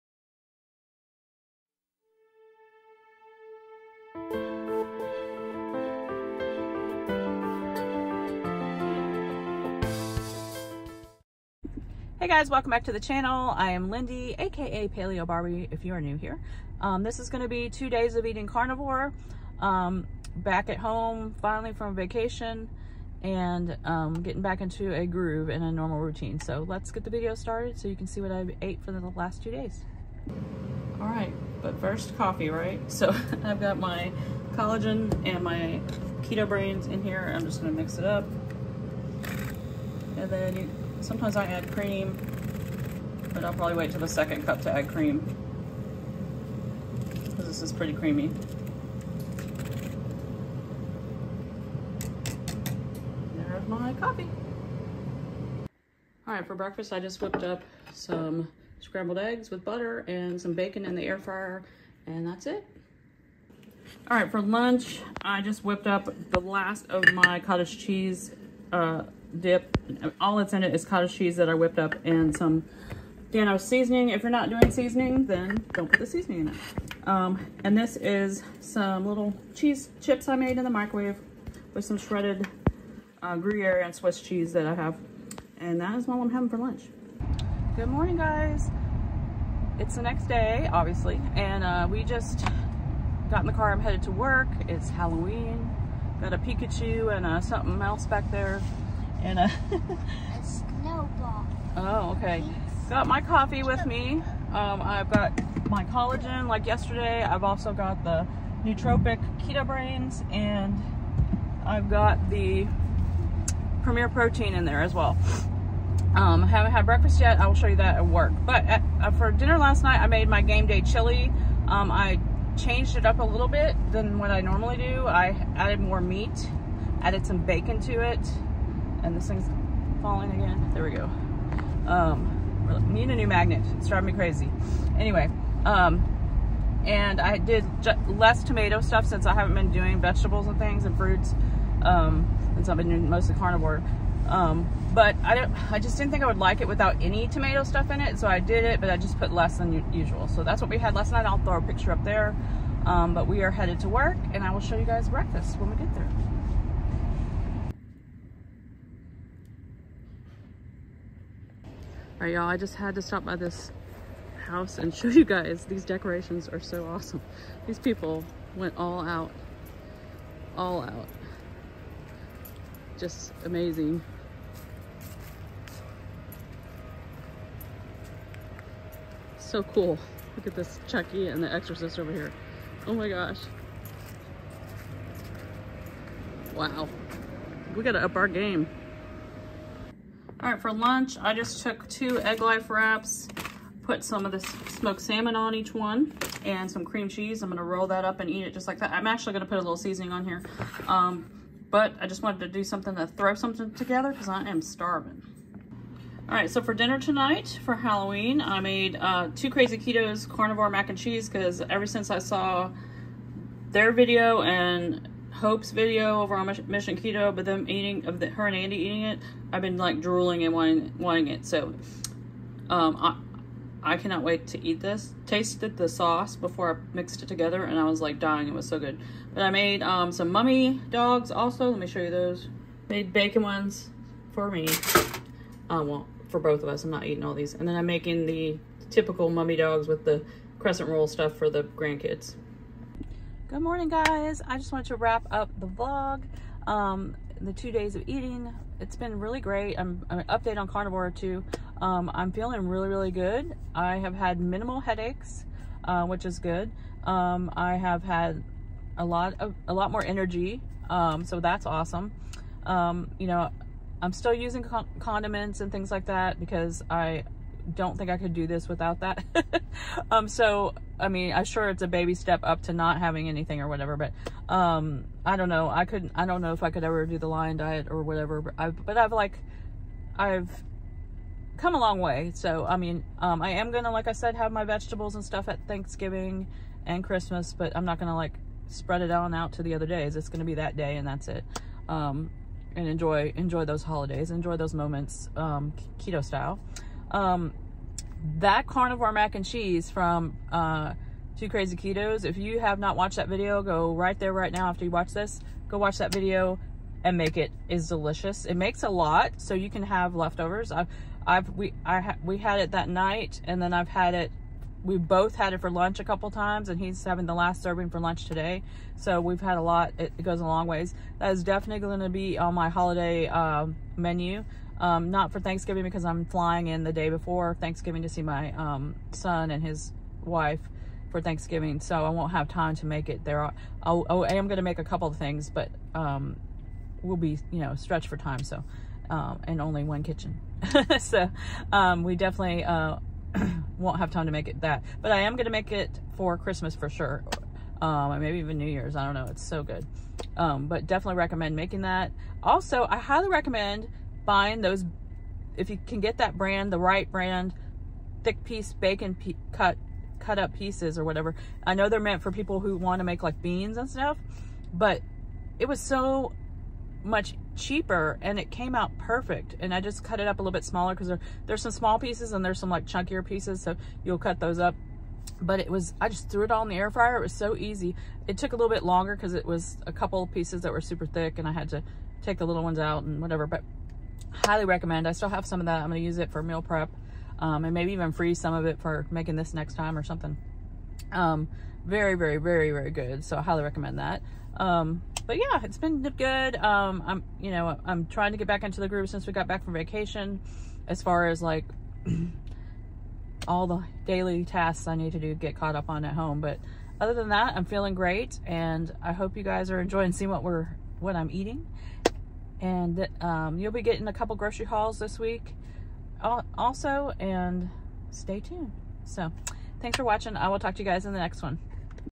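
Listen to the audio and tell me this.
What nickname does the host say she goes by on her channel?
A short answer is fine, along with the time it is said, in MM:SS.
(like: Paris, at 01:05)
Paleo Barbie, at 00:14.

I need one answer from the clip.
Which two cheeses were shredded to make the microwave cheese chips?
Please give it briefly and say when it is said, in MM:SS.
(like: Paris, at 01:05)
Gruyere and Swiss, at 01:23.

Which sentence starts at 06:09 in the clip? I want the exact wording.
And I just cut it up a little bit smaller because there, there's some small pieces and there's some like chunkier pieces.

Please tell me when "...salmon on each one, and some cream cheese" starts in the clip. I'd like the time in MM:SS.
03:14.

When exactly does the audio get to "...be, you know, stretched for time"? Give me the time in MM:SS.
05:37.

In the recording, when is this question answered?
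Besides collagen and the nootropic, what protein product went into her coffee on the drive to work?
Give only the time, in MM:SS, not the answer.
01:53.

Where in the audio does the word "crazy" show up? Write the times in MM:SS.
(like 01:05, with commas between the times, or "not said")
02:14, 03:29, 05:01.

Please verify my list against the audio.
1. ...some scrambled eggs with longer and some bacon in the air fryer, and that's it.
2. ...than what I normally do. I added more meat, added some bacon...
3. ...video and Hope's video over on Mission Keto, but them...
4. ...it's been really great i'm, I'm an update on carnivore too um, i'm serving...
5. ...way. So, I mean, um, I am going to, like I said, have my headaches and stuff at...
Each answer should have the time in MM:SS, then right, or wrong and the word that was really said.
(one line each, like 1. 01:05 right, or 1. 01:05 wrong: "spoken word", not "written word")
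1. 00:57 wrong: "butter", not "longer"
2. 02:03 right
3. 03:33 right
4. 04:08 wrong: "feeling", not "serving"
5. 04:41 wrong: "vegetables", not "headaches".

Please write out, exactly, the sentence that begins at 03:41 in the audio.
So, um, I, I cannot wait to eat this.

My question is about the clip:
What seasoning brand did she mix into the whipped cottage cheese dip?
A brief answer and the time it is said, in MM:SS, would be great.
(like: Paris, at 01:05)
Dino, at 01:13.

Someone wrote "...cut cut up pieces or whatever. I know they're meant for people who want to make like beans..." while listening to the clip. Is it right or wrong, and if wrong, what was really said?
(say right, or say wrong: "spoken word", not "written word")
right.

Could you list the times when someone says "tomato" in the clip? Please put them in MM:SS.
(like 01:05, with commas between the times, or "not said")
02:18, 02:27.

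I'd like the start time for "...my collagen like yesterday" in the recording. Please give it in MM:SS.
01:45.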